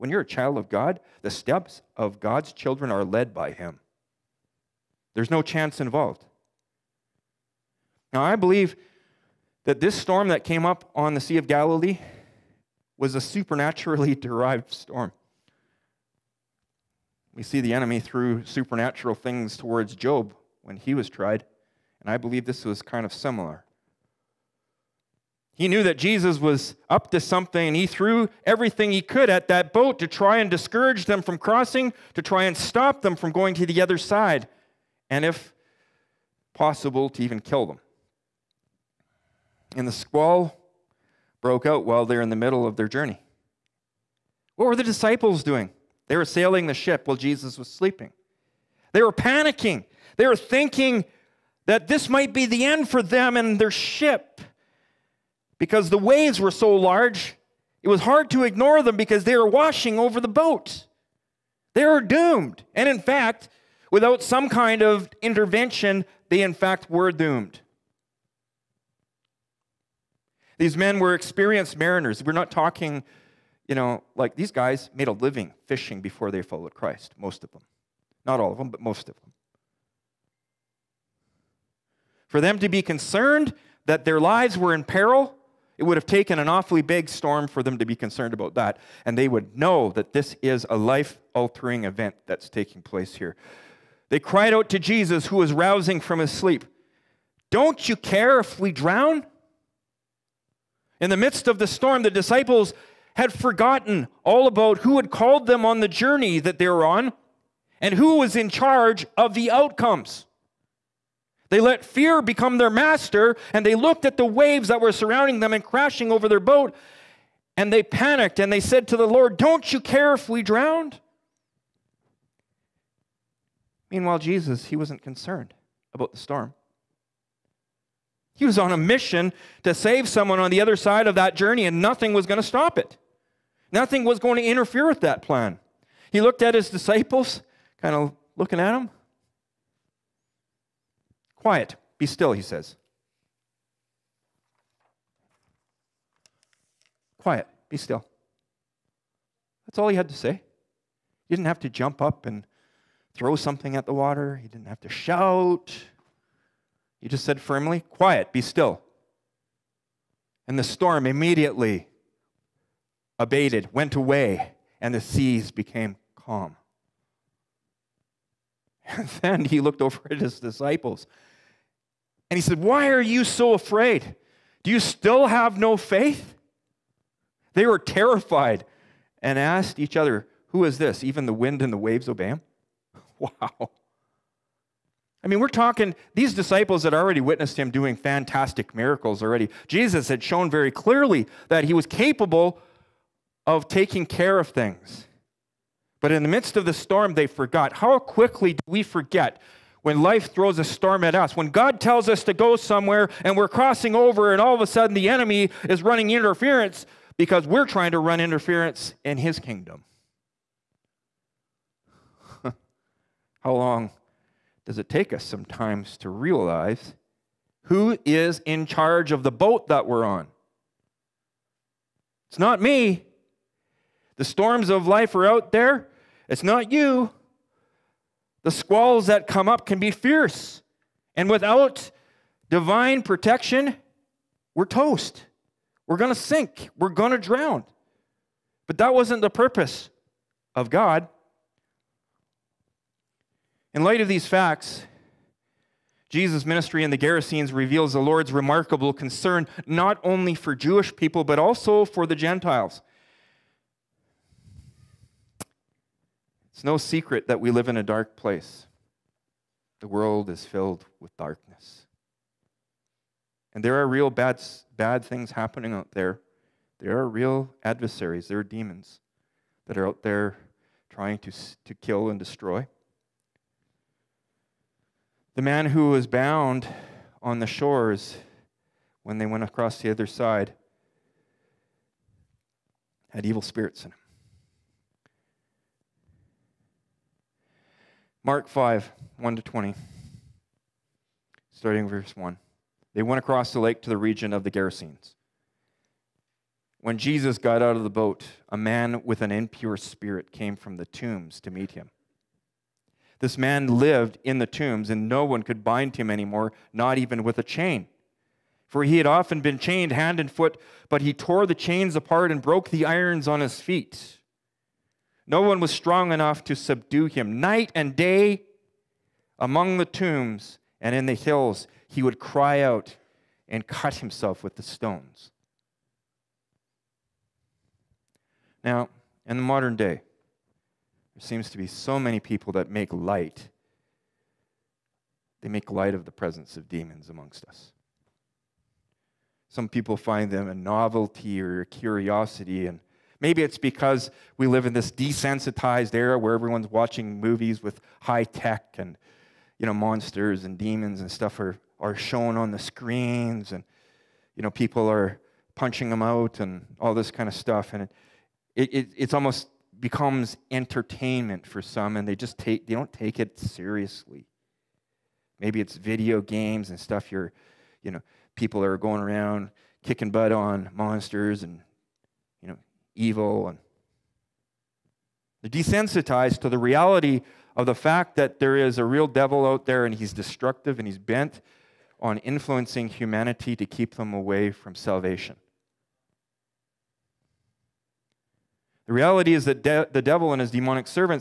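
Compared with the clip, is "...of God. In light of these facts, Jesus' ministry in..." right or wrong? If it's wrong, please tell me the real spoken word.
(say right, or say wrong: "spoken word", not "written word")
right.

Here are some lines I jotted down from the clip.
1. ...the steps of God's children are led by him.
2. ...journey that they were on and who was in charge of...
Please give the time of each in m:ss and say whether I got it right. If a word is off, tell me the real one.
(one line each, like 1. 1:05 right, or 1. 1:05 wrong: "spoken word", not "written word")
1. 0:01 right
2. 1:45 right.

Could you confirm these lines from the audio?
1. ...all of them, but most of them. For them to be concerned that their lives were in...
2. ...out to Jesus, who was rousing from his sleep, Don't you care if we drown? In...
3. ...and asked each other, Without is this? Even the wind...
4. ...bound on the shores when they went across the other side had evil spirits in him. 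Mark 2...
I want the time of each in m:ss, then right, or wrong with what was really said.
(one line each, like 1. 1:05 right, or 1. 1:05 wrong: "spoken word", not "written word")
1. 1:18 right
2. 1:34 right
3. 2:59 wrong: "Who", not "Without"
4. 4:36 wrong: "5", not "2".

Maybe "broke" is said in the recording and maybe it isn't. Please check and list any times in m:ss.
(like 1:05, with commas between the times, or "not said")
0:41, 5:12.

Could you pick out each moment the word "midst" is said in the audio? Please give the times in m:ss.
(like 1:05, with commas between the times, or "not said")
1:41, 3:16.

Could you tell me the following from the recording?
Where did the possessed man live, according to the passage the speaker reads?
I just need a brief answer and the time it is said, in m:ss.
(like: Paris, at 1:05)
in the tombs, at 5:04.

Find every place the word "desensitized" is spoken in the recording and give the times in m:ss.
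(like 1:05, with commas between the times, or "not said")
5:44, 6:15.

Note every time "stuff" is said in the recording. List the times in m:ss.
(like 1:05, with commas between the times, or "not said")
5:51, 5:57, 6:06.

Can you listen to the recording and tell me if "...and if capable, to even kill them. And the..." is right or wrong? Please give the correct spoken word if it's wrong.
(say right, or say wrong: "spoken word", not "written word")
wrong: "possible", not "capable".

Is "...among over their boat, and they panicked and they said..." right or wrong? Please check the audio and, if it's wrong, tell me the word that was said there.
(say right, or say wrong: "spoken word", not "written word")
wrong: "crashing", not "among".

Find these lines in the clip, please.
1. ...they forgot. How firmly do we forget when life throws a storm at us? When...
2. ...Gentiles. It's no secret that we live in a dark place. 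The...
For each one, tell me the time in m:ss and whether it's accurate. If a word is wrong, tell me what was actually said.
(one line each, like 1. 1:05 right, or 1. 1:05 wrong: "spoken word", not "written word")
1. 3:17 wrong: "quickly", not "firmly"
2. 4:12 right.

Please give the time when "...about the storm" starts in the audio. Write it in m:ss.
2:05.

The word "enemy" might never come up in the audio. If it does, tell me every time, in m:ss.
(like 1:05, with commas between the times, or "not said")
0:17, 3:25.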